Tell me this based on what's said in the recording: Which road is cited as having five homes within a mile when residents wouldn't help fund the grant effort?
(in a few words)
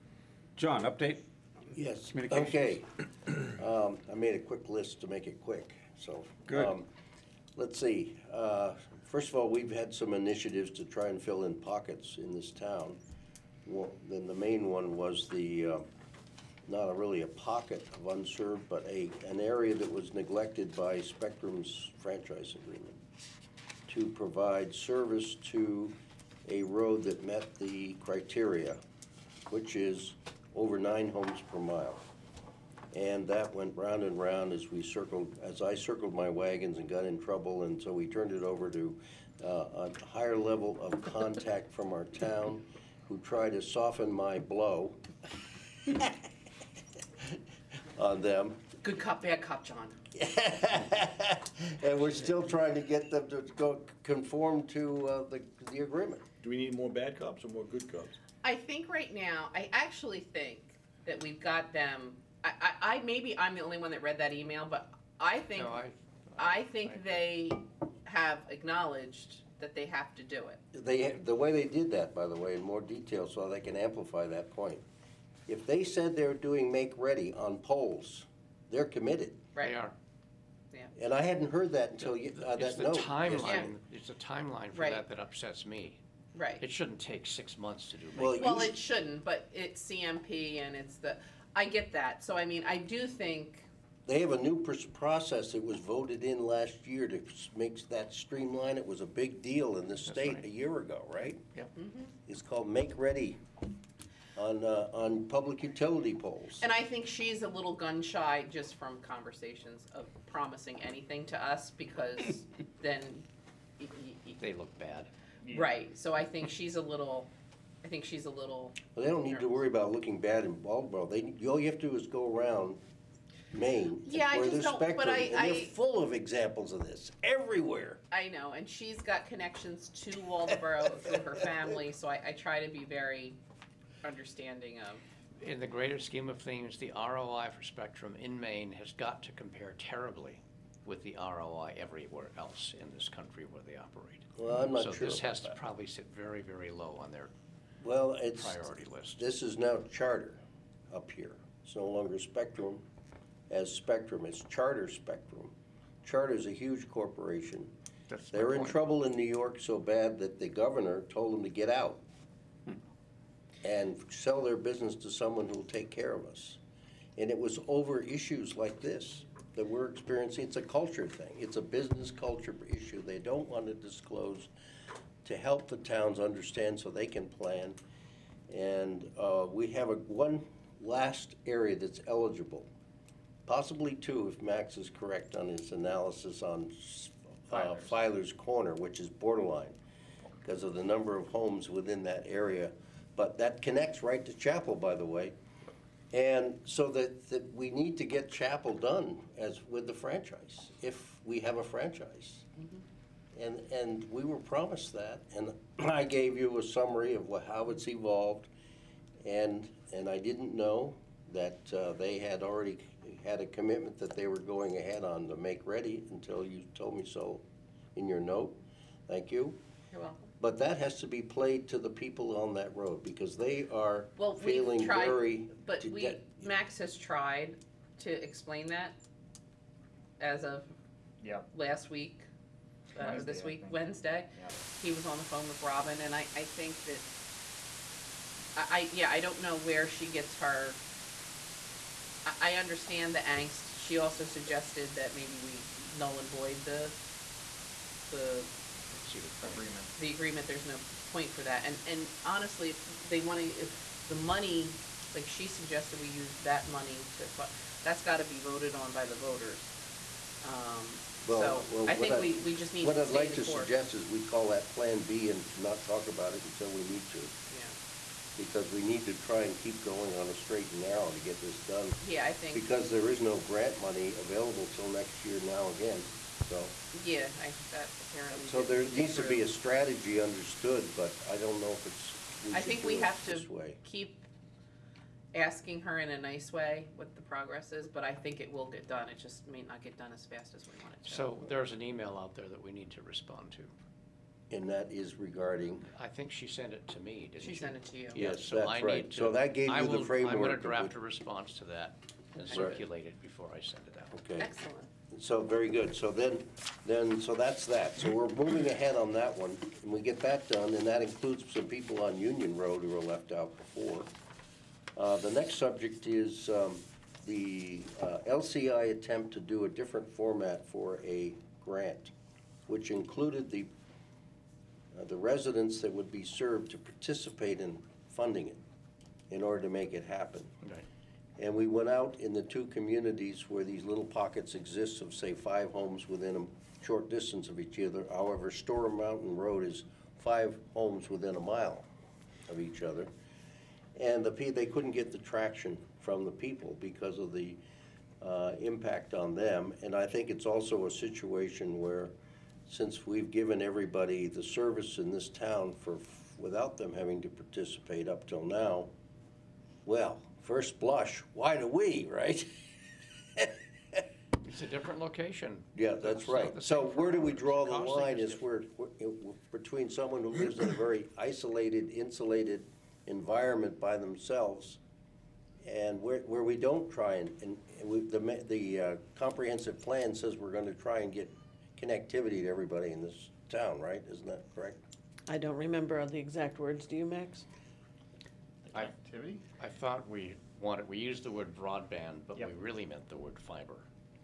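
Storm Mountain Road.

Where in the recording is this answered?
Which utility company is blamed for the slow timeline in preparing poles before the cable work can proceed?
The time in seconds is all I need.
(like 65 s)
89 s.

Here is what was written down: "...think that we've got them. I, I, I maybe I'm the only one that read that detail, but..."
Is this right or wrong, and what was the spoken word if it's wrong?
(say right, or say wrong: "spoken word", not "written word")
wrong: "email", not "detail".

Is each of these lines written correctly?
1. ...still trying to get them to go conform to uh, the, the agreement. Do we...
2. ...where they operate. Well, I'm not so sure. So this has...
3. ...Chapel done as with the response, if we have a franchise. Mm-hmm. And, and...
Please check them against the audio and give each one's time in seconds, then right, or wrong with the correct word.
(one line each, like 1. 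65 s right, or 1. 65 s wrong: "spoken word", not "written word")
1. 52 s right
2. 143 s right
3. 198 s wrong: "franchise", not "response".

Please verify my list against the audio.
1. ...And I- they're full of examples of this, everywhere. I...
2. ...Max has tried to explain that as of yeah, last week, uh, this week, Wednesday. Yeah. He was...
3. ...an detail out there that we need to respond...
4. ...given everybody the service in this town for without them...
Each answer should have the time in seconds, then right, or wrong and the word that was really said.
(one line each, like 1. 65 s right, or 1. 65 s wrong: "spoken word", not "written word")
1. 125 s right
2. 226 s right
3. 291 s wrong: "email", not "detail"
4. 353 s right.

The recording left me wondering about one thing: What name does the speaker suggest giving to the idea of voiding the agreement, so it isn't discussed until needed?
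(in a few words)
Plan B.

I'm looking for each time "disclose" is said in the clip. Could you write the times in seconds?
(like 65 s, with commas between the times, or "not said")
173 s.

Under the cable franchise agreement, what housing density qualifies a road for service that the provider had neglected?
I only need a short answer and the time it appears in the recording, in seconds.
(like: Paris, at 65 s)
over 9 homes per mile, at 30 s.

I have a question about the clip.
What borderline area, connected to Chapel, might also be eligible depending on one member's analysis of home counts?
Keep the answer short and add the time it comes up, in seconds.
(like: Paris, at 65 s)
Filer's Corner, at 187 s.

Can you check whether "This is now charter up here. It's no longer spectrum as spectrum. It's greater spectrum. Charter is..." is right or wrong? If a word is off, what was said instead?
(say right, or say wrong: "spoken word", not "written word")
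wrong: "charter", not "greater".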